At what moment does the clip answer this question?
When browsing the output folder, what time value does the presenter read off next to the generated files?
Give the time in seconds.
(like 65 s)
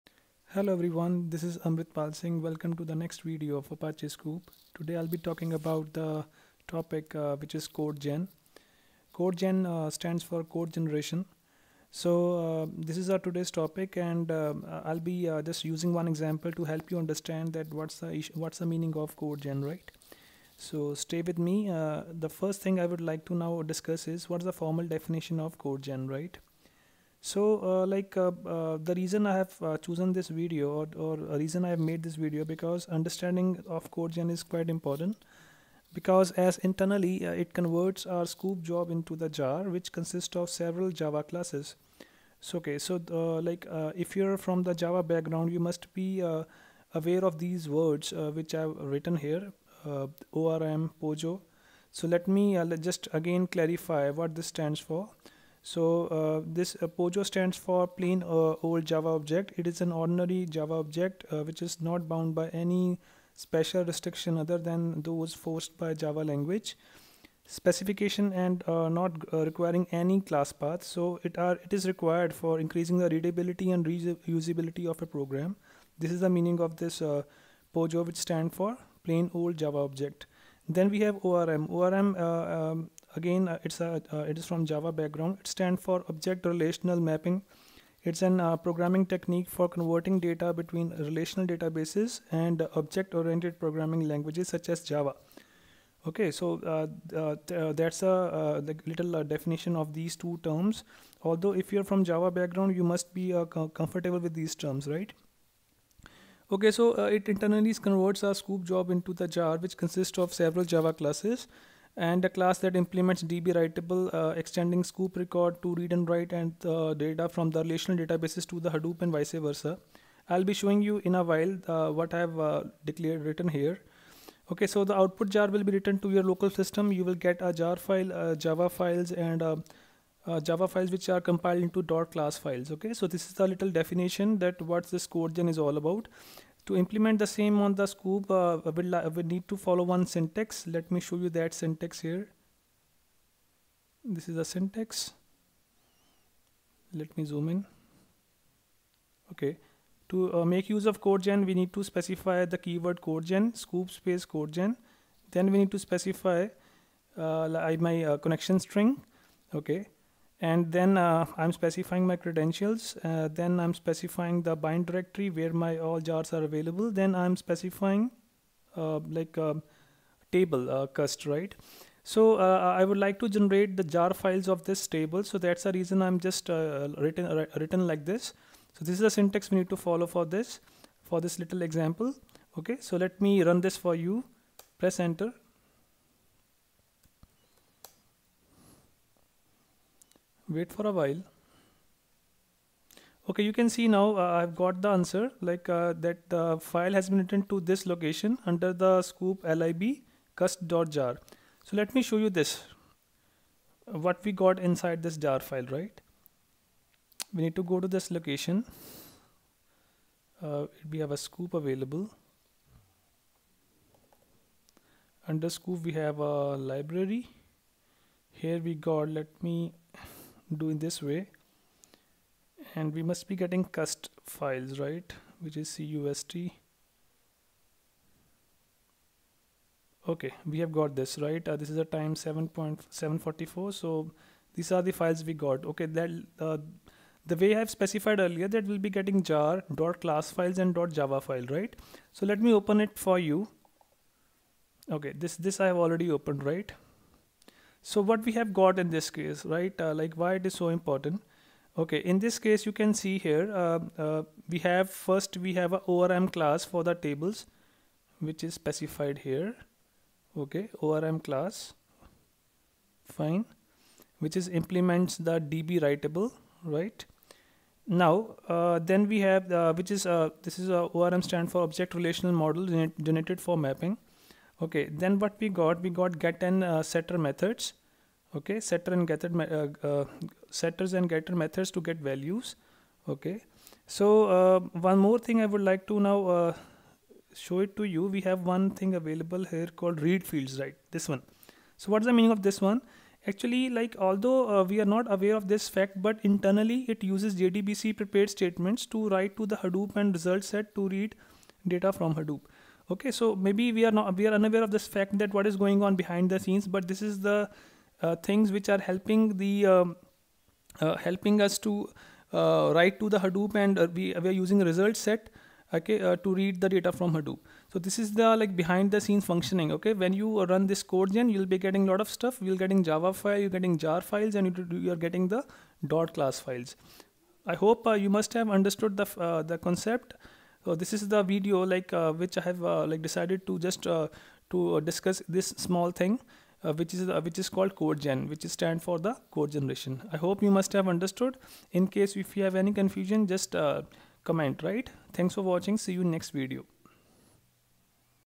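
232 s.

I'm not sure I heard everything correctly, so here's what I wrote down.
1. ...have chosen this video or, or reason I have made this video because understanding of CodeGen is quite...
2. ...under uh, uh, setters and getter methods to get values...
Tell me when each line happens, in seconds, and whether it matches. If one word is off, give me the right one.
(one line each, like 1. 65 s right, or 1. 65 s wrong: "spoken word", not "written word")
1. 29 s right
2. 279 s wrong: "getter", not "under".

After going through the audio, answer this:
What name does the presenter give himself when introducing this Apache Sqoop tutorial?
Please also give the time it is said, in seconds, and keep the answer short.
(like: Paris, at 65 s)
Pal Singh, at 1 s.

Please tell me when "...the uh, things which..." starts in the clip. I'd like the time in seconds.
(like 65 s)
307 s.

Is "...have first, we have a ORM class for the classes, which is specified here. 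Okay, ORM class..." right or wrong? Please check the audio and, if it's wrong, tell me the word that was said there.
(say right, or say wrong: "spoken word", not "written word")
wrong: "tables", not "classes".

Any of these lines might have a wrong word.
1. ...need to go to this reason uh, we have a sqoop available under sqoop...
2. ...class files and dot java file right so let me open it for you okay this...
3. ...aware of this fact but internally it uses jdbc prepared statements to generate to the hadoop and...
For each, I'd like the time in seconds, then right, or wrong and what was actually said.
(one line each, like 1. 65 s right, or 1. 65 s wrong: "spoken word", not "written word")
1. 207 s wrong: "location", not "reason"
2. 240 s right
3. 295 s wrong: "write", not "generate".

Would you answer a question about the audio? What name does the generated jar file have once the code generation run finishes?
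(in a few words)
cust.jar.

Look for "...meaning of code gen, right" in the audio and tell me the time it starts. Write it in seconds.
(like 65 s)
18 s.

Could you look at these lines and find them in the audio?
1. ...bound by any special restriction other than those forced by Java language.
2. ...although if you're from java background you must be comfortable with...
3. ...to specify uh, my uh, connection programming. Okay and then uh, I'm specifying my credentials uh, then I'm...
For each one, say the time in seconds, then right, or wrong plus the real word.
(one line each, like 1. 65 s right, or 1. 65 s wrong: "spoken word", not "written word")
1. 62 s right
2. 101 s right
3. 155 s wrong: "string", not "programming".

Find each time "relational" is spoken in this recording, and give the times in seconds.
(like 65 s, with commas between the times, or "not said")
86 s, 90 s, 117 s, 271 s.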